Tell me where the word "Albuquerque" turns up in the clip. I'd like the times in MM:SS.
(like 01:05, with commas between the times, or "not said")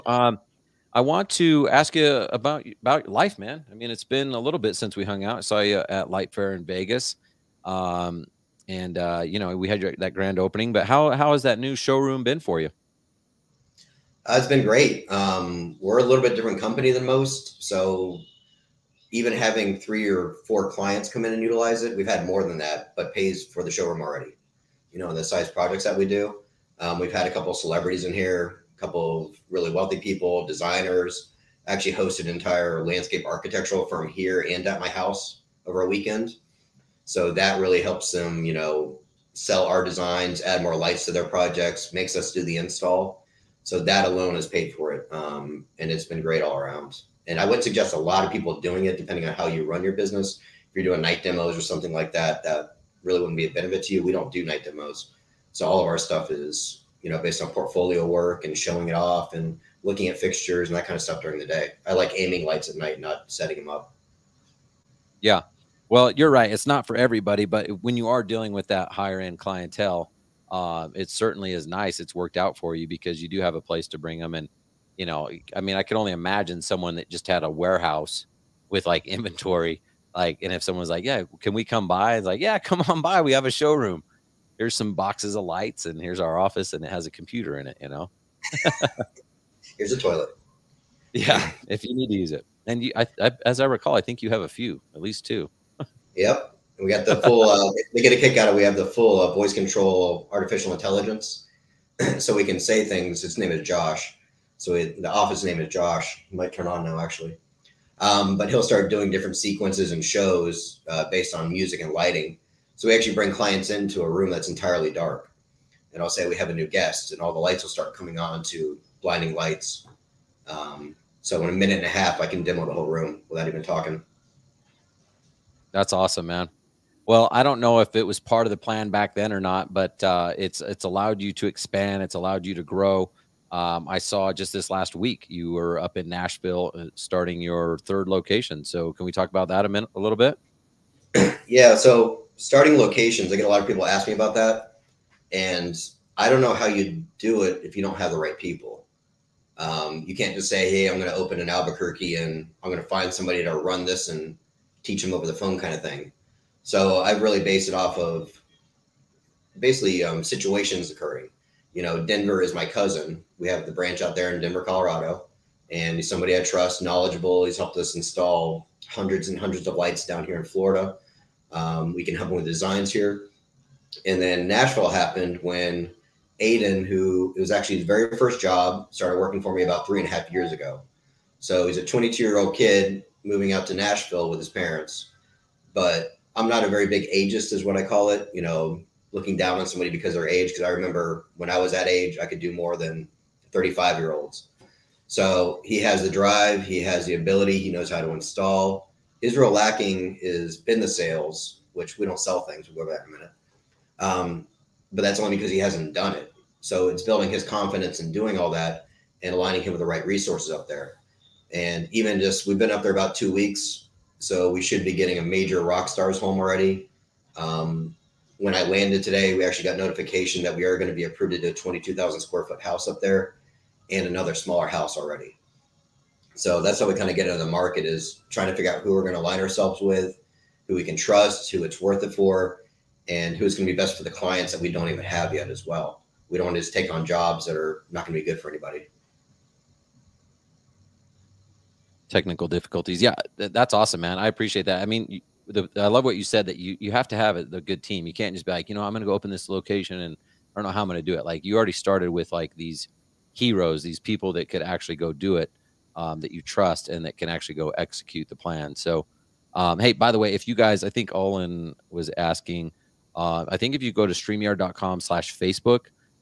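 02:31.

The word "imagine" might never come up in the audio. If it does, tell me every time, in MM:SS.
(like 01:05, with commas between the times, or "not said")
01:16.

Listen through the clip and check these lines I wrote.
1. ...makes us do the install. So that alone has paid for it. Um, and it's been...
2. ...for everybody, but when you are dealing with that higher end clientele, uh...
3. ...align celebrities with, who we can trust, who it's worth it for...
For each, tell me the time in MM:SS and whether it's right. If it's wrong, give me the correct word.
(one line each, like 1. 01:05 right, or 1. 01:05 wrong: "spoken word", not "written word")
1. 00:41 right
2. 01:06 right
3. 03:49 wrong: "ourselves", not "celebrities".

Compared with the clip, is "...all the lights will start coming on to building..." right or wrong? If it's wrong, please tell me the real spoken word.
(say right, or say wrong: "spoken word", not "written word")
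wrong: "blinding", not "building".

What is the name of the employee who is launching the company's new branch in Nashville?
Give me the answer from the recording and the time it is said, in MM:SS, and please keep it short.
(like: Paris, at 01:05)
Aiden, at 02:56.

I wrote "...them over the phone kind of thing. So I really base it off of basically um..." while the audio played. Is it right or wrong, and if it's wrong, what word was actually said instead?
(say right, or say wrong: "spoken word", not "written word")
right.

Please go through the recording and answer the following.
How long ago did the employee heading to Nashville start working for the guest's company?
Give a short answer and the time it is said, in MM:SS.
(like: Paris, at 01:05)
3 and a half years, at 02:59.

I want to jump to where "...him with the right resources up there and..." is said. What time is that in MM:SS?
03:29.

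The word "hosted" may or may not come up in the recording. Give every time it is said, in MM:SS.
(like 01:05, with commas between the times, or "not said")
00:31.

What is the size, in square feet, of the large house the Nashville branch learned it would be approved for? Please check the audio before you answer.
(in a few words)
22,000 square feet.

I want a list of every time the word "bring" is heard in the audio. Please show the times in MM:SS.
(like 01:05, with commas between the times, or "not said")
01:13, 01:53.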